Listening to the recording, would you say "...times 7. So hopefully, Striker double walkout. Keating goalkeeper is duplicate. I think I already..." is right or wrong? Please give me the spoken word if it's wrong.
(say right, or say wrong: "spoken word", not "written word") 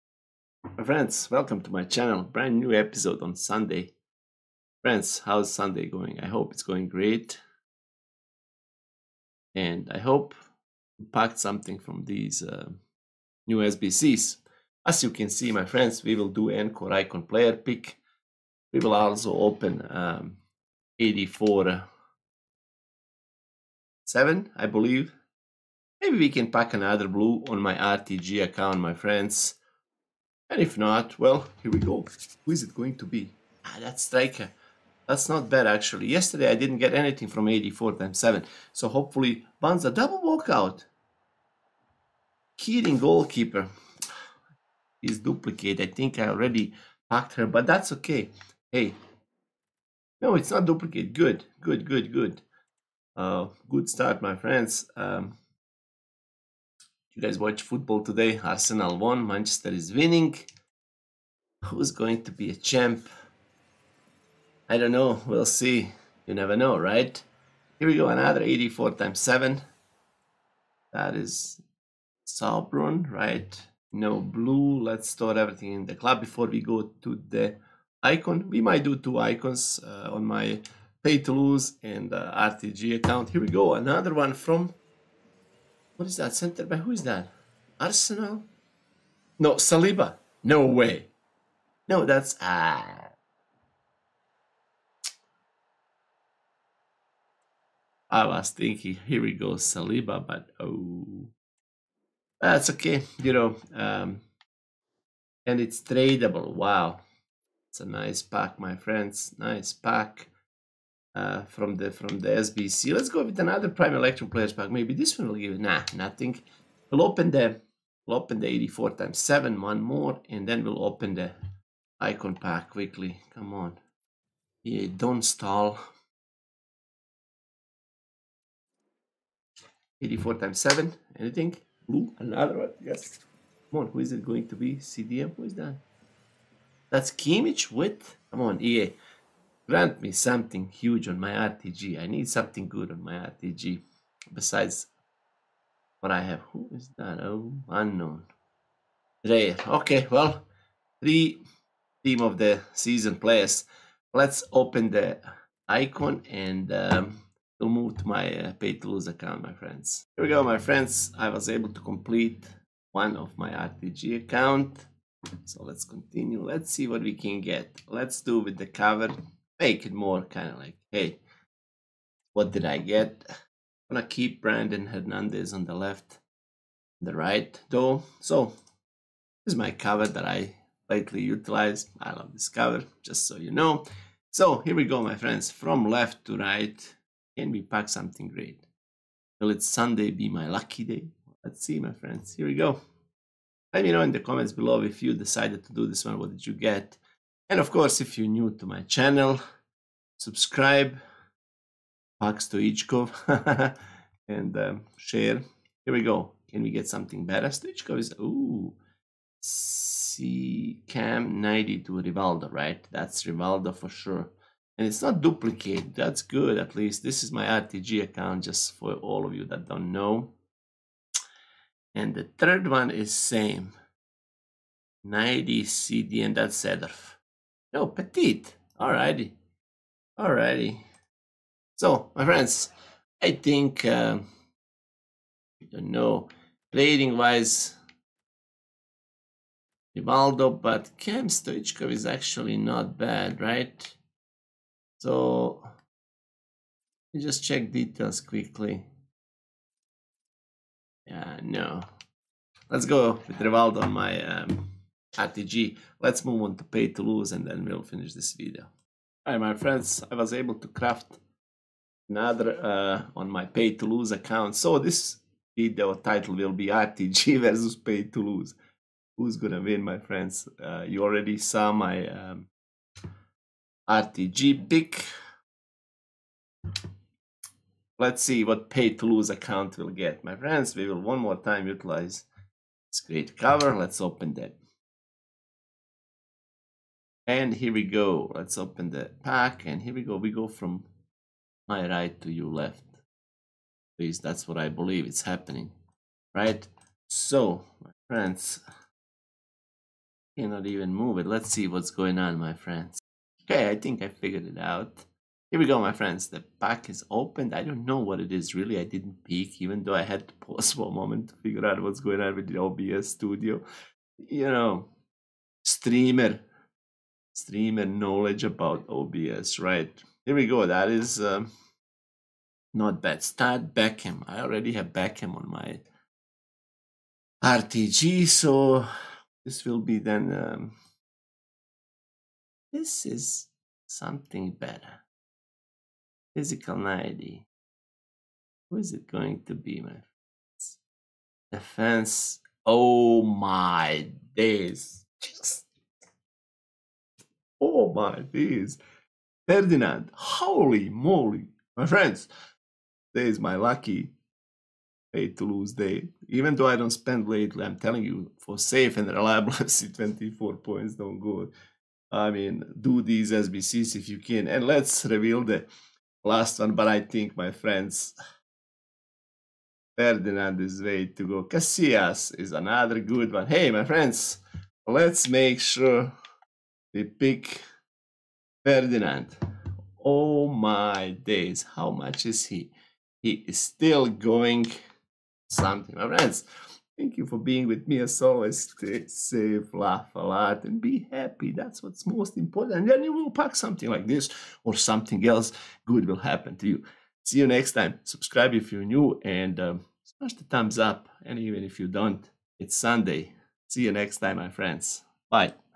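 wrong: "Banza", not "Striker".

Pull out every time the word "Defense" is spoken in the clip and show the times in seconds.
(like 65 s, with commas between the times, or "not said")
341 s.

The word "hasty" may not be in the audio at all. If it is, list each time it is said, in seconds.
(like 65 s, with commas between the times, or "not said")
not said.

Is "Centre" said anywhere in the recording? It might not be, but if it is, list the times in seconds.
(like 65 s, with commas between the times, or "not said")
86 s.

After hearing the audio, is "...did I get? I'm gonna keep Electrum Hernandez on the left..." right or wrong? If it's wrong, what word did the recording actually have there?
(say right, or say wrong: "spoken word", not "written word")
wrong: "Brandon", not "Electrum".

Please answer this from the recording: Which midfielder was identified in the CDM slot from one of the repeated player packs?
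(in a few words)
Kimmich.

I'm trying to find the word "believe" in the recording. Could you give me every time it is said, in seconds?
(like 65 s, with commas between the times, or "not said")
24 s, 294 s.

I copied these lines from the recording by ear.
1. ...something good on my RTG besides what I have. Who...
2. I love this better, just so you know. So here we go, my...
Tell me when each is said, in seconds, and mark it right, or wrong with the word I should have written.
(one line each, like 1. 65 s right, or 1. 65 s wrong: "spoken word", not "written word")
1. 142 s right
2. 182 s wrong: "cover", not "better".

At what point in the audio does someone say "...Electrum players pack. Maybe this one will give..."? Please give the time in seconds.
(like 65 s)
113 s.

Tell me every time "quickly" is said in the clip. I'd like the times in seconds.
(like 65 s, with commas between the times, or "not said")
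122 s, 248 s.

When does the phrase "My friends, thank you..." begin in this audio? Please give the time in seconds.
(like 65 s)
385 s.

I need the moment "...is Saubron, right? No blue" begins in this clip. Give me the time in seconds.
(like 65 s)
71 s.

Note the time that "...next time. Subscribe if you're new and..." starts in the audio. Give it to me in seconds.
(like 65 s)
397 s.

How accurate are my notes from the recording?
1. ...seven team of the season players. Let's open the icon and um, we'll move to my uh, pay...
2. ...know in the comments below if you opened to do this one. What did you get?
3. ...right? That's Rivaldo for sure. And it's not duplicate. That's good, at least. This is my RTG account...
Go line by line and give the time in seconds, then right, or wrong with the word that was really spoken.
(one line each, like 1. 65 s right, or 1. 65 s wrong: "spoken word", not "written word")
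1. 151 s wrong: "three", not "seven"
2. 193 s wrong: "decided", not "opened"
3. 212 s right.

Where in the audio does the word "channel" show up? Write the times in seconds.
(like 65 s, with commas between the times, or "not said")
1 s, 198 s.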